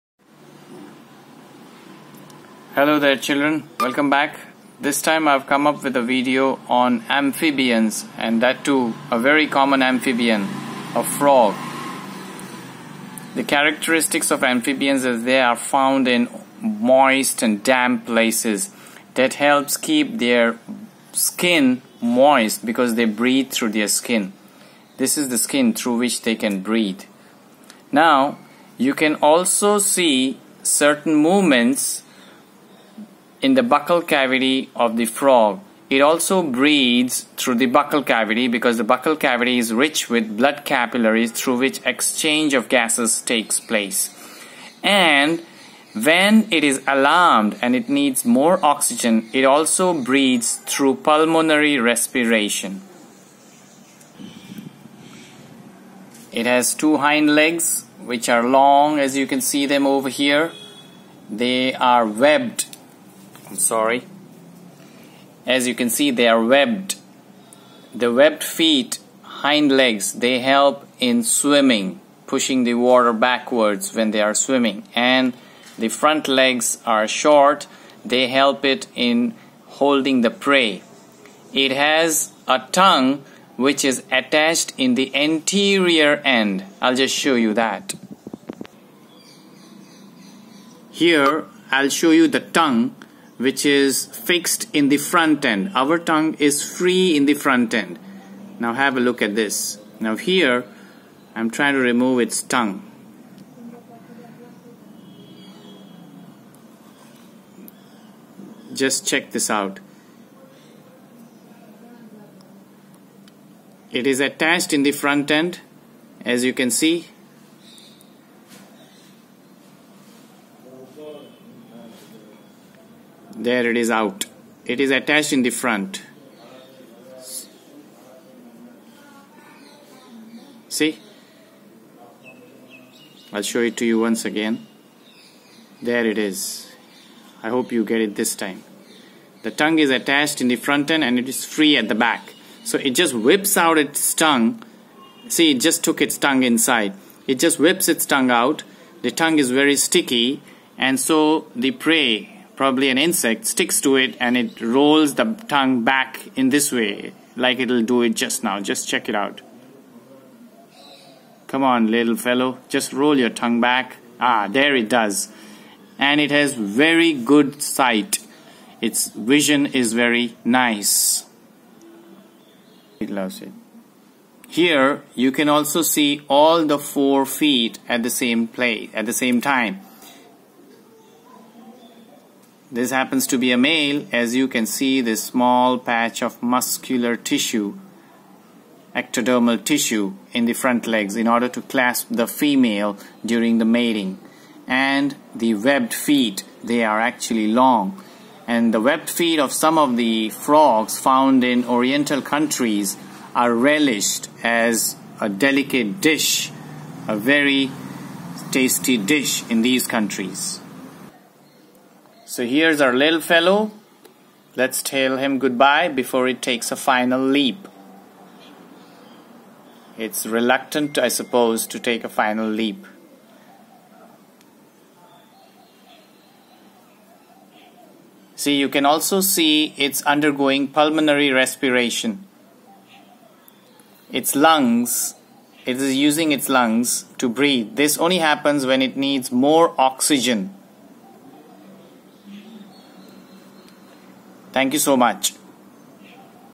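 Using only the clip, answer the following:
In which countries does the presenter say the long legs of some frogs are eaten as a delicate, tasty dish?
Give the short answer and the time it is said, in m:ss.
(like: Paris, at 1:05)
Oriental countries, at 3:21.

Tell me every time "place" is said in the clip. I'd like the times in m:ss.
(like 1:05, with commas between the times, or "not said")
0:18, 0:43, 2:58.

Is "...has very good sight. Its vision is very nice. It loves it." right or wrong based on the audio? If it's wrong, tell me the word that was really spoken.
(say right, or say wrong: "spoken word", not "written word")
right.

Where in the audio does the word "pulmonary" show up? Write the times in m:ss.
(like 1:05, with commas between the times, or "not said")
0:50, 3:50.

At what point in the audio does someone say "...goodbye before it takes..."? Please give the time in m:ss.
3:35.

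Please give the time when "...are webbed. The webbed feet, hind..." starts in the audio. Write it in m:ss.
1:06.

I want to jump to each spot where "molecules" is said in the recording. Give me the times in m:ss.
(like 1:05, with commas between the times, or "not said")
not said.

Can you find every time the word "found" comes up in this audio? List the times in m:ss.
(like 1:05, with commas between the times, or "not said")
0:15, 3:20.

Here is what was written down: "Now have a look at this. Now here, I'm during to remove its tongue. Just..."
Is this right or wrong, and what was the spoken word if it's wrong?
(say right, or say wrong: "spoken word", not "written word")
wrong: "trying", not "during".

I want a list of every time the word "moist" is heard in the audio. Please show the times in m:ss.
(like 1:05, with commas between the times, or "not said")
0:16, 0:22.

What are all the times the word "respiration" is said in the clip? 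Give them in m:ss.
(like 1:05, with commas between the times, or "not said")
0:51, 3:51.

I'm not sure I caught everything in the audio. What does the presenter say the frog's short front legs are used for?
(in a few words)
Holding the prey.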